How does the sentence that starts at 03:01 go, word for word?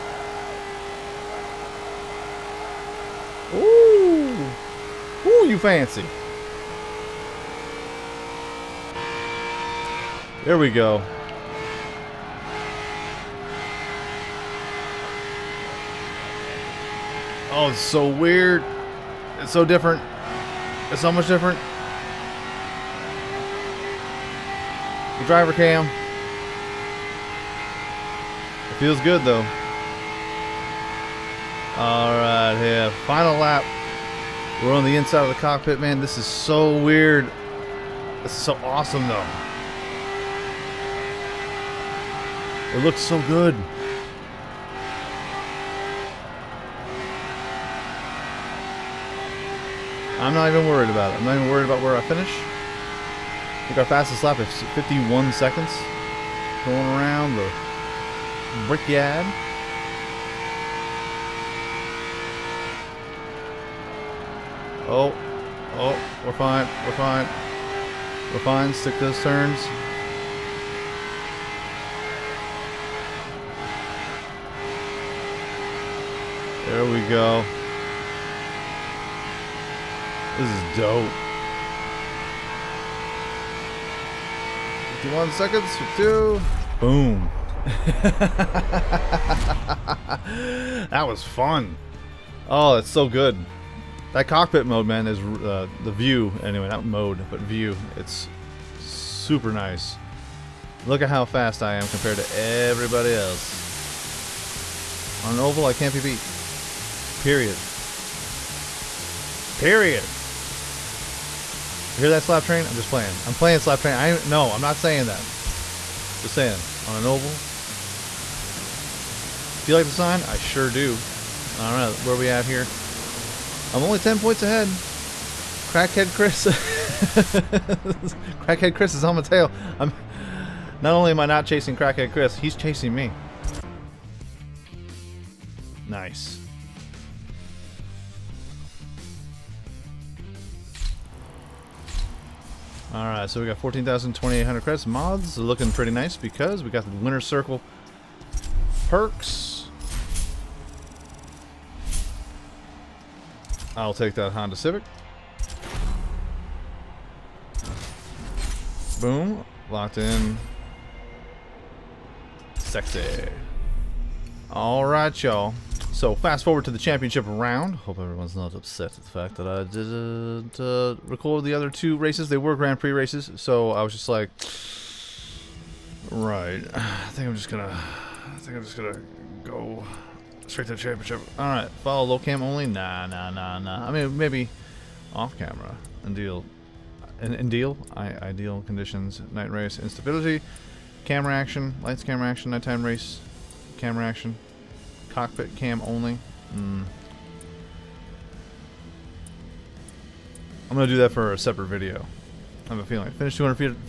All right, follow low cam only.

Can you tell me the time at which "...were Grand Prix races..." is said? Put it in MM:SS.
02:52.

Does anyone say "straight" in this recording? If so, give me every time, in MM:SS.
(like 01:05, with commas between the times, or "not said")
03:00.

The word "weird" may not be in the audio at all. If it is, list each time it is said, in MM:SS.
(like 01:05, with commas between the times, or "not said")
00:18, 00:36.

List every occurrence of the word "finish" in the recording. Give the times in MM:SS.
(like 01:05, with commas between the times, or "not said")
00:52, 03:23.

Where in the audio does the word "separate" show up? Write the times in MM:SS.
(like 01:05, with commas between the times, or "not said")
03:21.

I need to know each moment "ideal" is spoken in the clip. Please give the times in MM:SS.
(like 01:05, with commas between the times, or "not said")
03:08.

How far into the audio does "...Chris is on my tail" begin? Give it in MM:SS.
02:08.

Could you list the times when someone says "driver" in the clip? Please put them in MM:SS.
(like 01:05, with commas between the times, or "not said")
00:25.